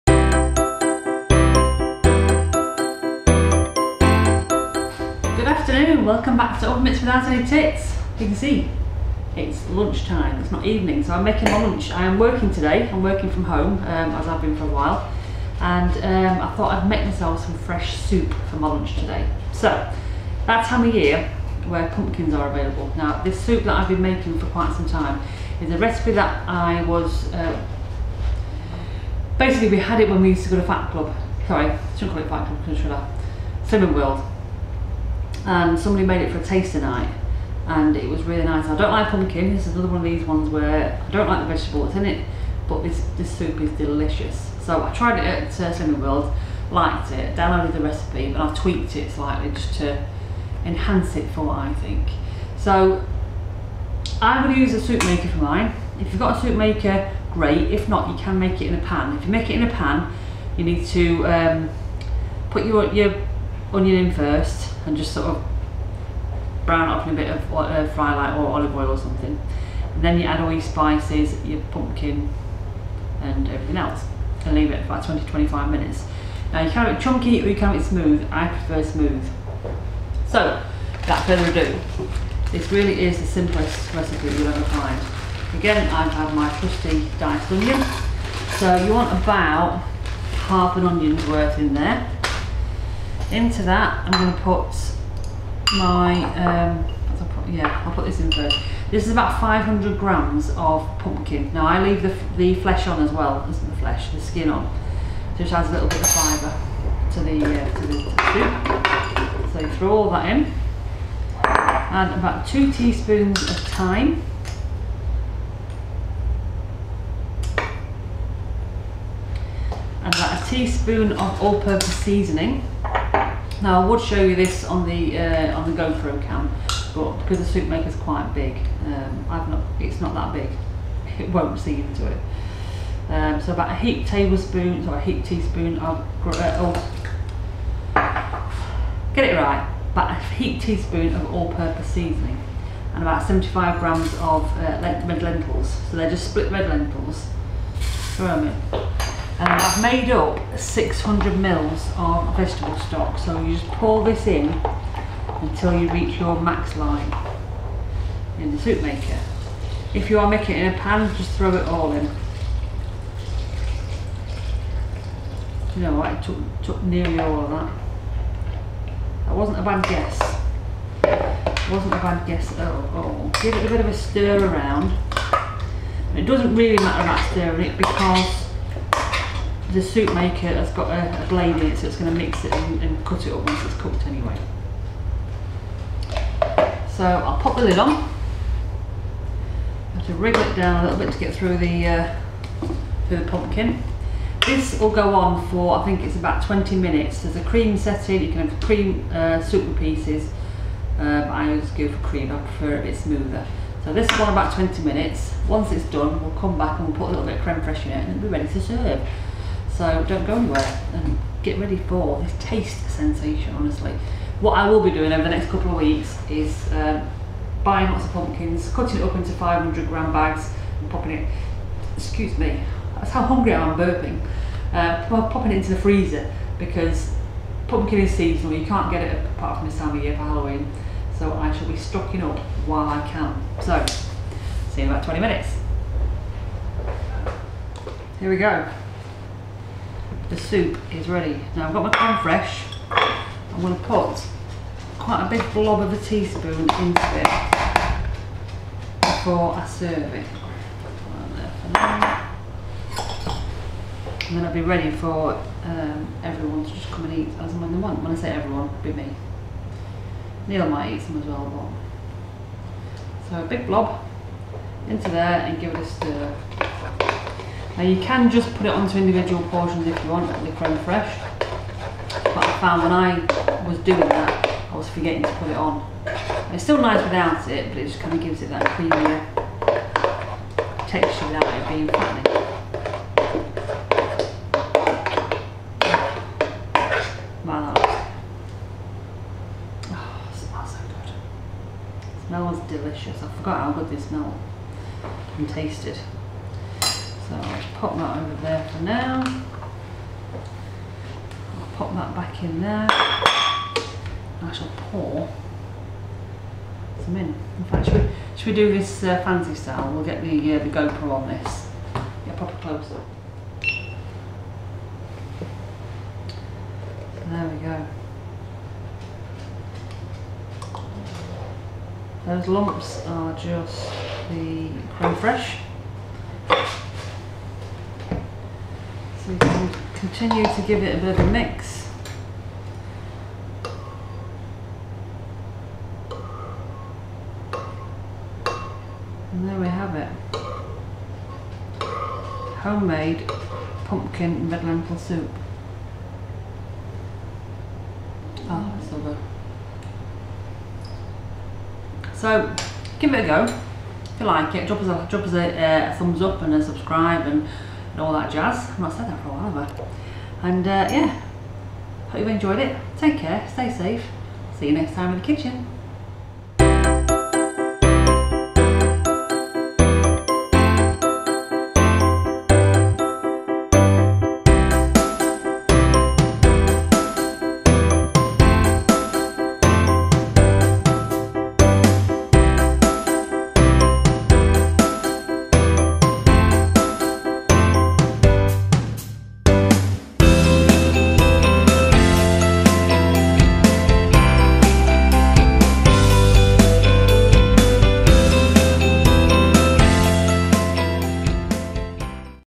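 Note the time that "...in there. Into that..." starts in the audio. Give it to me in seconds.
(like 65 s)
91 s.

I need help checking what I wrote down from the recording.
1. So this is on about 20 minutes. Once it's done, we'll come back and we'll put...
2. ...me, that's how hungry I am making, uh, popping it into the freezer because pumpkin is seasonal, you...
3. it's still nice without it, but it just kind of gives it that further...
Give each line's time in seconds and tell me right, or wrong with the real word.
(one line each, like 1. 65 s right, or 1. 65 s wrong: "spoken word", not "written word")
1. 203 s right
2. 222 s wrong: "burping", not "making"
3. 276 s wrong: "creamier", not "further".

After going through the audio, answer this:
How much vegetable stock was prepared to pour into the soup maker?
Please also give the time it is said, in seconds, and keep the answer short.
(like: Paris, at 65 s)
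600 ml, at 150 s.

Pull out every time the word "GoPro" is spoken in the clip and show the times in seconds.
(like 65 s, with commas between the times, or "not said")
125 s, 310 s.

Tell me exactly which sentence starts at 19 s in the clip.
So, that time of year where pumpkins are available.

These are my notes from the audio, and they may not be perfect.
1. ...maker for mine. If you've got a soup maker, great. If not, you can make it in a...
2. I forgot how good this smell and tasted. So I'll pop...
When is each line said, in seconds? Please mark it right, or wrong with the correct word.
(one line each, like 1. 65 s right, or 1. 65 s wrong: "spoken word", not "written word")
1. 55 s right
2. 293 s right.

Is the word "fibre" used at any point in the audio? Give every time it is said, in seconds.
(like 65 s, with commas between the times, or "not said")
106 s.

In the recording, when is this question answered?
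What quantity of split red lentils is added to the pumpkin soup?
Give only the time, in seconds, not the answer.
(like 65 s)
143 s.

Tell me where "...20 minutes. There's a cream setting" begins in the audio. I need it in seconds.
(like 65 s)
196 s.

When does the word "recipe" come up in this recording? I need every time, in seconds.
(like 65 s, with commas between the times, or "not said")
25 s, 47 s, 83 s.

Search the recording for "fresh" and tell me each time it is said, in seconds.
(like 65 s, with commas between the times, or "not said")
17 s, 242 s.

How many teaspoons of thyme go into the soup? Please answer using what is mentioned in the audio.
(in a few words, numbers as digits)
2.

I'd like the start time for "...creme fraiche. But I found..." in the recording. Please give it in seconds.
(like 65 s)
270 s.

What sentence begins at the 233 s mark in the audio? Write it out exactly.
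So, see you in about 20 minutes.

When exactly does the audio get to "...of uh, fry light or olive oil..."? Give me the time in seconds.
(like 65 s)
67 s.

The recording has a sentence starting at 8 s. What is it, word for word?
You can see, it's lunchtime, it's not evening, so I'm making my lunch.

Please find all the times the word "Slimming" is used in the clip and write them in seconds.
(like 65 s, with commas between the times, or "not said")
33 s, 45 s.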